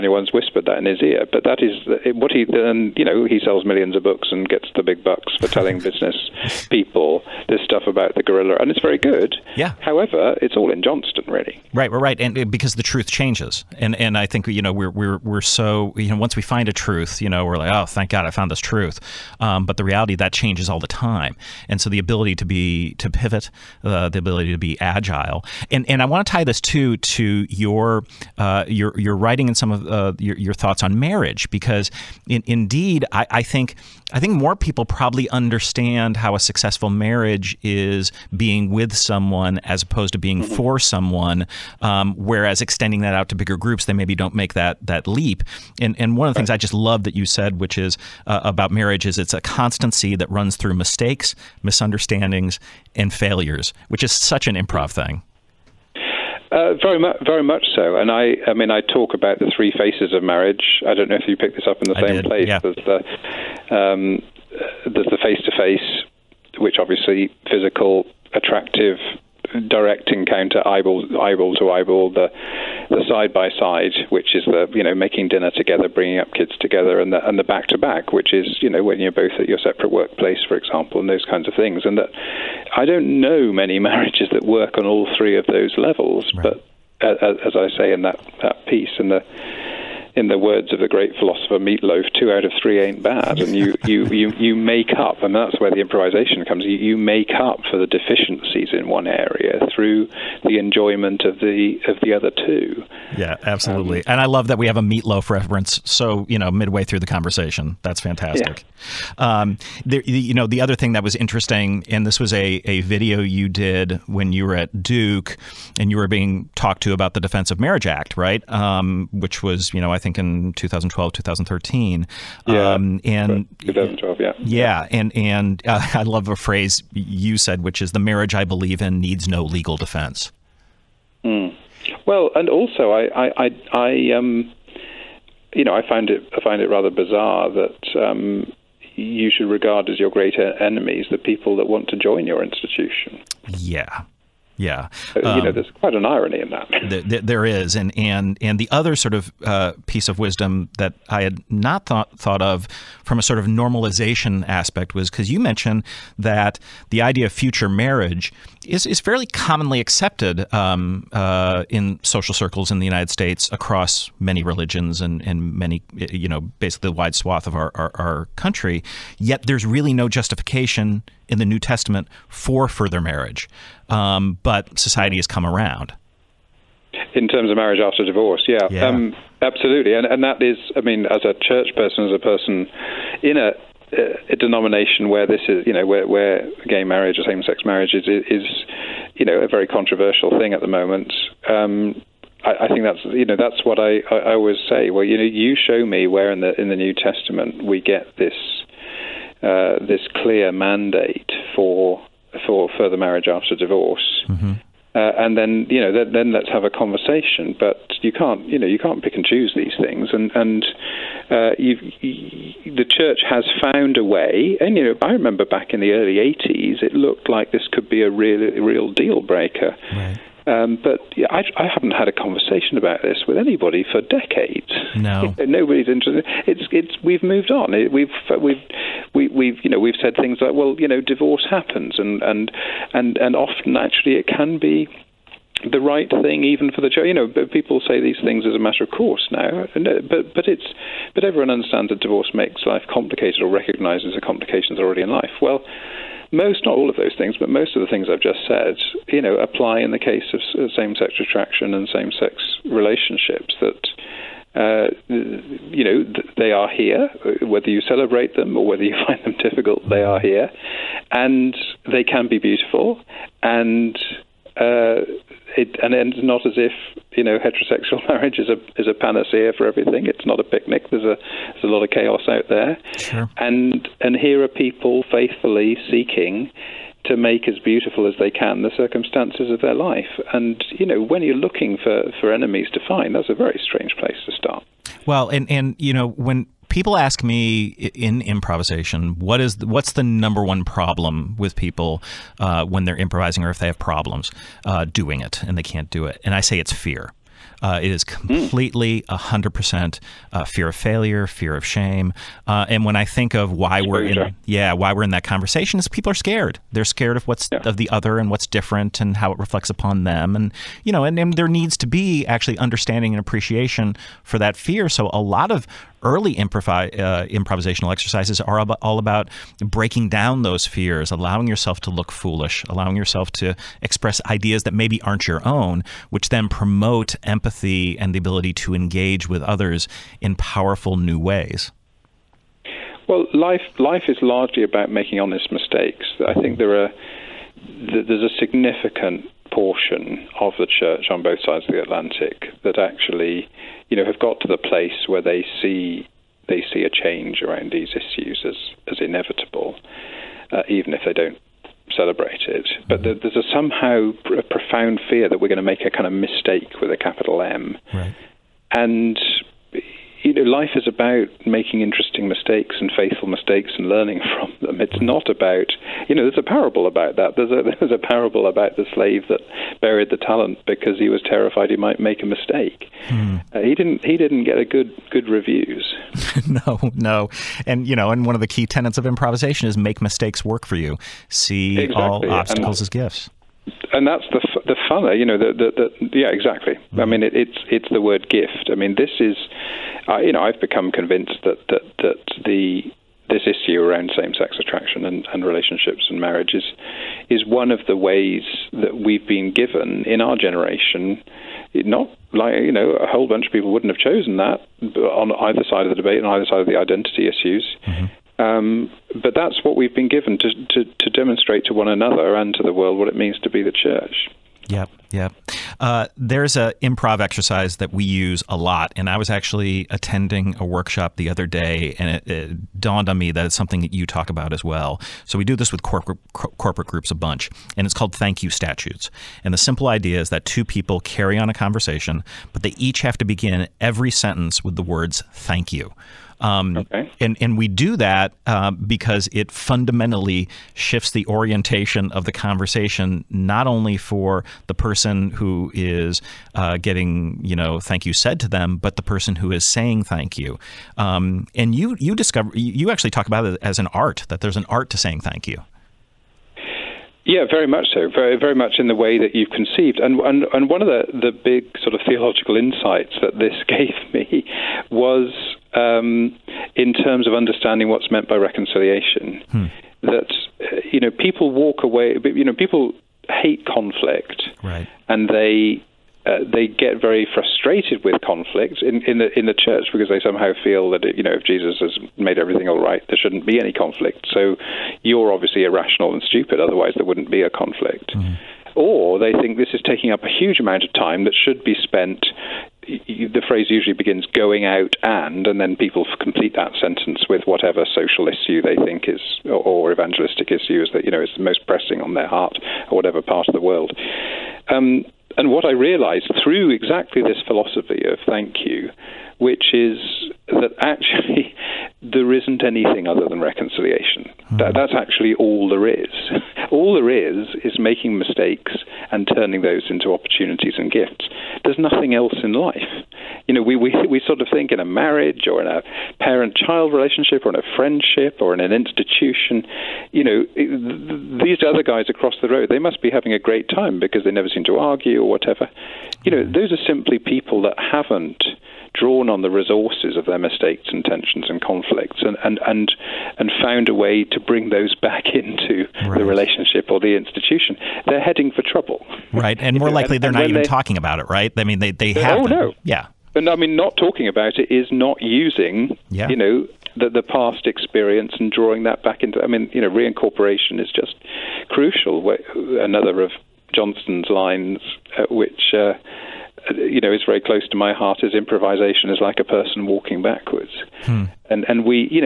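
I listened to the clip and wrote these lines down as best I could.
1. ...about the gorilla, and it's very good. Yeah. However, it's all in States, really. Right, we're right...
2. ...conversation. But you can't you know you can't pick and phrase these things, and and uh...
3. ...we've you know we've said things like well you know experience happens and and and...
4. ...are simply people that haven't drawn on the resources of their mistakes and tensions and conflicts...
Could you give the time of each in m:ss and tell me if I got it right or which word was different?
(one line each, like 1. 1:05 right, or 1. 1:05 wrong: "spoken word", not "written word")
1. 0:07 wrong: "Johnstone", not "States"
2. 3:26 wrong: "choose", not "phrase"
3. 3:49 wrong: "divorce", not "experience"
4. 8:56 right.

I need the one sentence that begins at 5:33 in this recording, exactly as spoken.
Well, life life is largely about making honest mistakes.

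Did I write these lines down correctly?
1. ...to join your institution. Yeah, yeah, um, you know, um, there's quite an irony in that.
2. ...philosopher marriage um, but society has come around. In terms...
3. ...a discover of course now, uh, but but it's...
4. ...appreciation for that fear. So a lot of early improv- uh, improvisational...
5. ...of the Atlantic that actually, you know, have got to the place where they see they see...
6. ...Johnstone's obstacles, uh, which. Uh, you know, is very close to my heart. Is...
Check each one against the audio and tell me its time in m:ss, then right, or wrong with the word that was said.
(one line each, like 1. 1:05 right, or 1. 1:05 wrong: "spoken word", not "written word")
1. 2:21 right
2. 2:52 wrong: "further", not "philosopher"
3. 3:58 wrong: "matter", not "discover"
4. 5:13 right
5. 5:41 right
6. 9:23 wrong: "lines", not "obstacles".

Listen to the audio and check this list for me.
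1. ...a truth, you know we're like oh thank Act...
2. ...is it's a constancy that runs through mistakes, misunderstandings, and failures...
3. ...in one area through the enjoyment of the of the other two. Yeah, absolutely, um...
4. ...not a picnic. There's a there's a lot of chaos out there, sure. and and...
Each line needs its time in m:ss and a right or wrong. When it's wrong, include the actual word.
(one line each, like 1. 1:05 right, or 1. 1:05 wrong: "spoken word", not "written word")
1. 0:16 wrong: "God", not "Act"
2. 0:49 right
3. 1:38 right
4. 4:30 right.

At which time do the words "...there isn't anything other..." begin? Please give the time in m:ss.
8:32.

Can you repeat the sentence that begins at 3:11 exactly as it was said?
Um, I, I, think that's, you know, that's what I, I, always say.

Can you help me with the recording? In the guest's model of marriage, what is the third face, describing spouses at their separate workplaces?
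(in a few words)
back to back.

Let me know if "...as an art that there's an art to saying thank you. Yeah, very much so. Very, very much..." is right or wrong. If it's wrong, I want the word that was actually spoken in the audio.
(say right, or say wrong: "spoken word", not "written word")
right.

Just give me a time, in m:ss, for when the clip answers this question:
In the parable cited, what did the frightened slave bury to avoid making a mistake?
6:10.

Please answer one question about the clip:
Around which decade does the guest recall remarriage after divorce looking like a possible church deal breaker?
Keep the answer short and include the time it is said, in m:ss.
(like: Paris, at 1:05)
early 1980s, at 3:35.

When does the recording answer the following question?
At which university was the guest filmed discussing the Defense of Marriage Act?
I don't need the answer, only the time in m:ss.
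1:54.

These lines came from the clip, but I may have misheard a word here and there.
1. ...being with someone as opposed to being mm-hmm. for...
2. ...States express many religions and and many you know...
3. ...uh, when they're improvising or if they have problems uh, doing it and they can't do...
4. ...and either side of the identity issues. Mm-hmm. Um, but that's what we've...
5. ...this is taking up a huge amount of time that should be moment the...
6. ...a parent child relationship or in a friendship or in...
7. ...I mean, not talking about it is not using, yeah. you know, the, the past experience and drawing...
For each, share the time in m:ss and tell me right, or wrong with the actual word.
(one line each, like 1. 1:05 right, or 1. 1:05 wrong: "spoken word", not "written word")
1. 0:38 right
2. 2:43 wrong: "across", not "express"
3. 4:52 right
4. 6:46 right
5. 8:09 wrong: "spent", not "moment"
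6. 8:45 right
7. 9:13 right.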